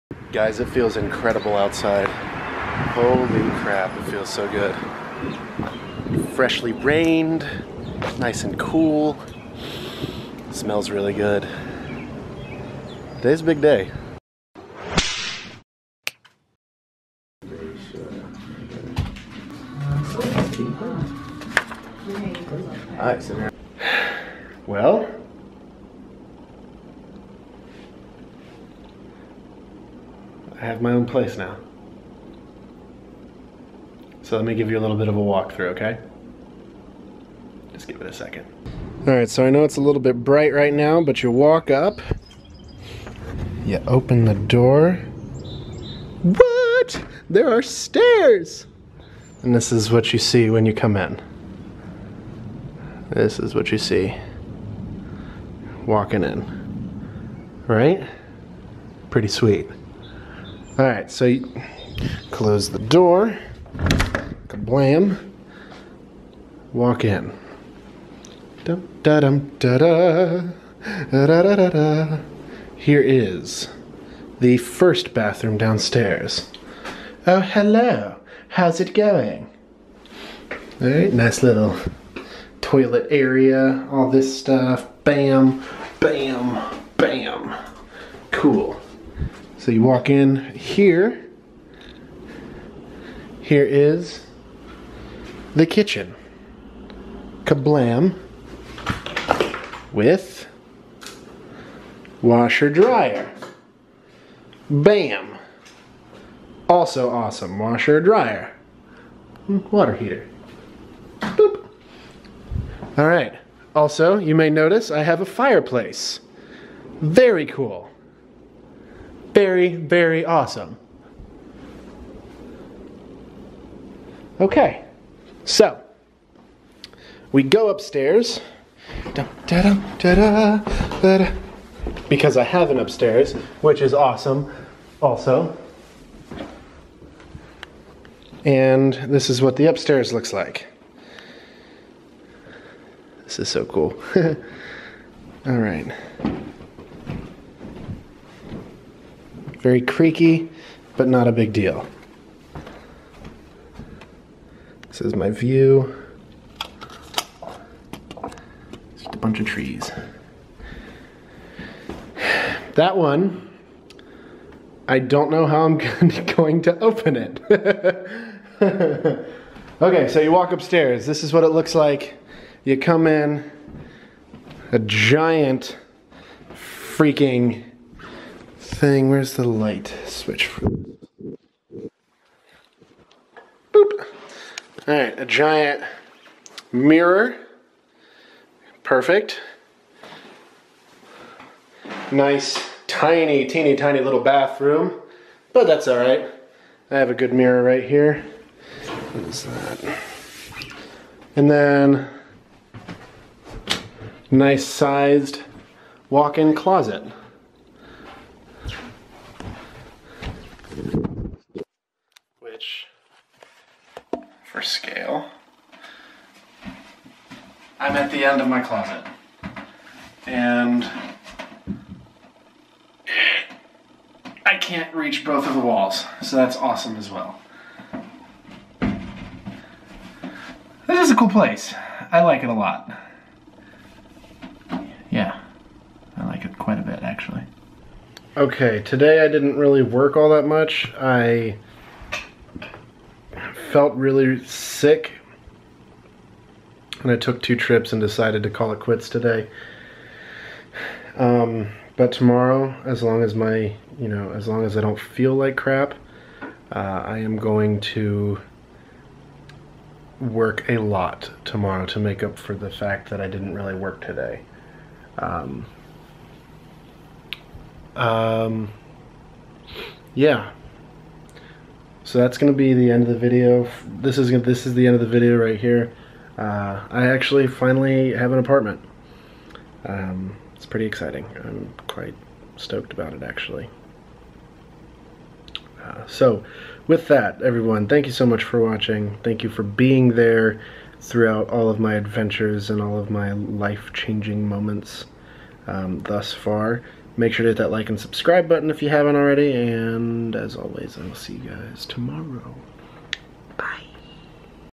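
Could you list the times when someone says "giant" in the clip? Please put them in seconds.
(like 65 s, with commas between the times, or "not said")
174 s, 185 s.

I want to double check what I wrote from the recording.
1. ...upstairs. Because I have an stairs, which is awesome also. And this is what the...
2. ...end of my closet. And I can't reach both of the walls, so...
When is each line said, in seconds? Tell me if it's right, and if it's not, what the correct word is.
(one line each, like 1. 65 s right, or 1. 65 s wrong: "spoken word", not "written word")
1. 127 s wrong: "upstairs", not "stairs"
2. 218 s right.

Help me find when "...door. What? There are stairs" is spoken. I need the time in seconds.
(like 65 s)
44 s.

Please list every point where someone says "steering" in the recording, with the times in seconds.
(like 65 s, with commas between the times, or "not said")
not said.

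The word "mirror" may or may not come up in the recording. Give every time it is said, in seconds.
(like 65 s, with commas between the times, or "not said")
186 s, 197 s.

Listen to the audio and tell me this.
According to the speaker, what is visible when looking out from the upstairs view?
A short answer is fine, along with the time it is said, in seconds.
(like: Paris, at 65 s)
A bunch of trees, at 159 s.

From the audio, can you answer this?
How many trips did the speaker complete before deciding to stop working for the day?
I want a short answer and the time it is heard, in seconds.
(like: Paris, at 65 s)
2, at 247 s.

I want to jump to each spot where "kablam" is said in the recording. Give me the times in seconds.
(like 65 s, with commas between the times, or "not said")
64 s, 97 s.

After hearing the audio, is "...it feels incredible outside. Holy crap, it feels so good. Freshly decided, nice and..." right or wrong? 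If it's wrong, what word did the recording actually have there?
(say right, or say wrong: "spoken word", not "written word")
wrong: "rained", not "decided".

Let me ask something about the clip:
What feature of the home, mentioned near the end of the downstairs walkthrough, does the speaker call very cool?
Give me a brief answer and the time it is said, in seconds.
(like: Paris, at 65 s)
A fireplace, at 115 s.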